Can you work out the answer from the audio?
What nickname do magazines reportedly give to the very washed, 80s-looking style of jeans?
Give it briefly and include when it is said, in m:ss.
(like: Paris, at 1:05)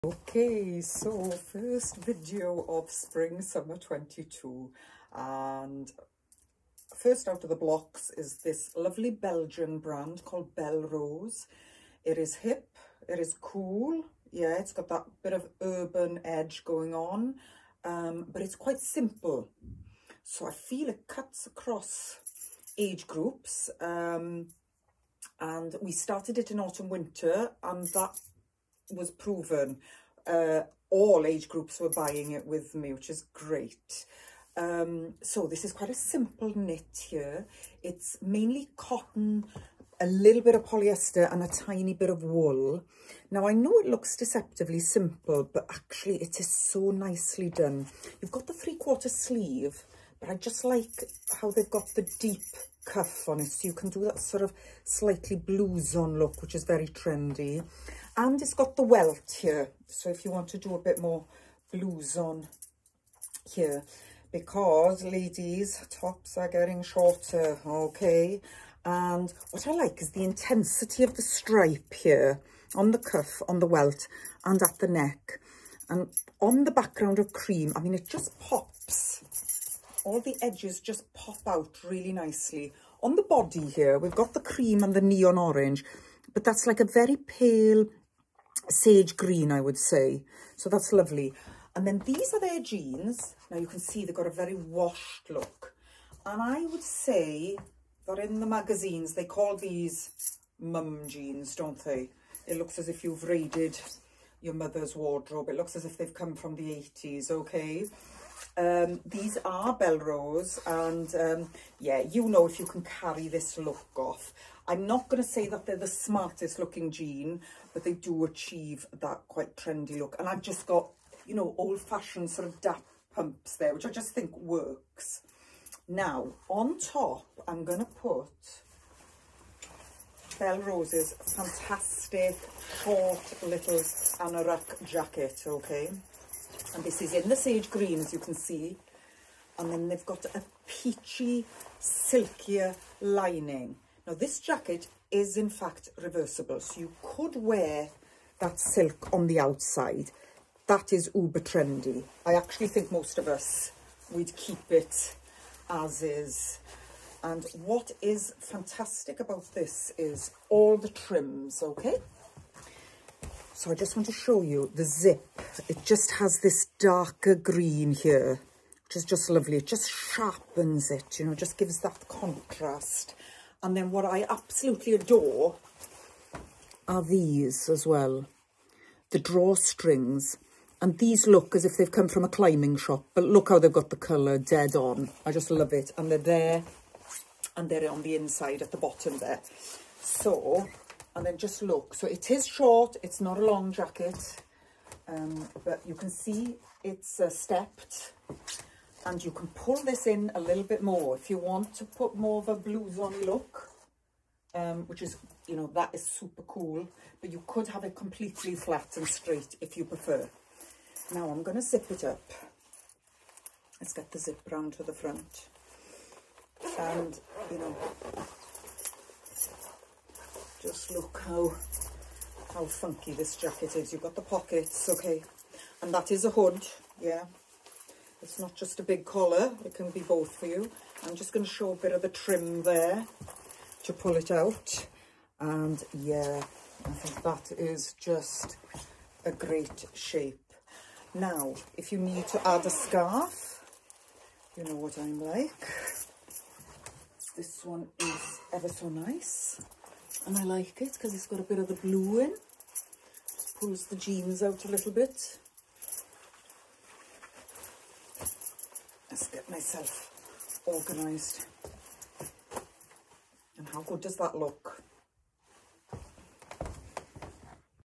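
mum jeans, at 1:40.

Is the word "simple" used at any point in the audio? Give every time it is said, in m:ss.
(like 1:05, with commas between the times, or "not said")
0:18, 0:35, 0:44.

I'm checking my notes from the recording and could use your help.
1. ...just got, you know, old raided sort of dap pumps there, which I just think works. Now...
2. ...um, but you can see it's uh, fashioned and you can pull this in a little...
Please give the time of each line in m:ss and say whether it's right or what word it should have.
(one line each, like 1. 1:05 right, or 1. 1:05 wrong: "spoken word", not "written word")
1. 2:00 wrong: "fashioned", not "raided"
2. 3:15 wrong: "stepped", not "fashioned".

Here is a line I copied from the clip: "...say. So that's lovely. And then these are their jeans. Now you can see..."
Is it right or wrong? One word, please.
right.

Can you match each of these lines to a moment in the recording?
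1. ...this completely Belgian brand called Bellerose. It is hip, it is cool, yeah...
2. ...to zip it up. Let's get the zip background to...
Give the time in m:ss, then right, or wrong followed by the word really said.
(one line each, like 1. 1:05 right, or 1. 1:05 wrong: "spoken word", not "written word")
1. 0:08 wrong: "lovely", not "completely"
2. 3:31 wrong: "round", not "background".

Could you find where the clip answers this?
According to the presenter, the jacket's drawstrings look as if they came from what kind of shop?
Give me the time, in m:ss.
3:02.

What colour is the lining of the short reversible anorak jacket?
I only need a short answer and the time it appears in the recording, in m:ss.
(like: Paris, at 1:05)
peachy, at 2:20.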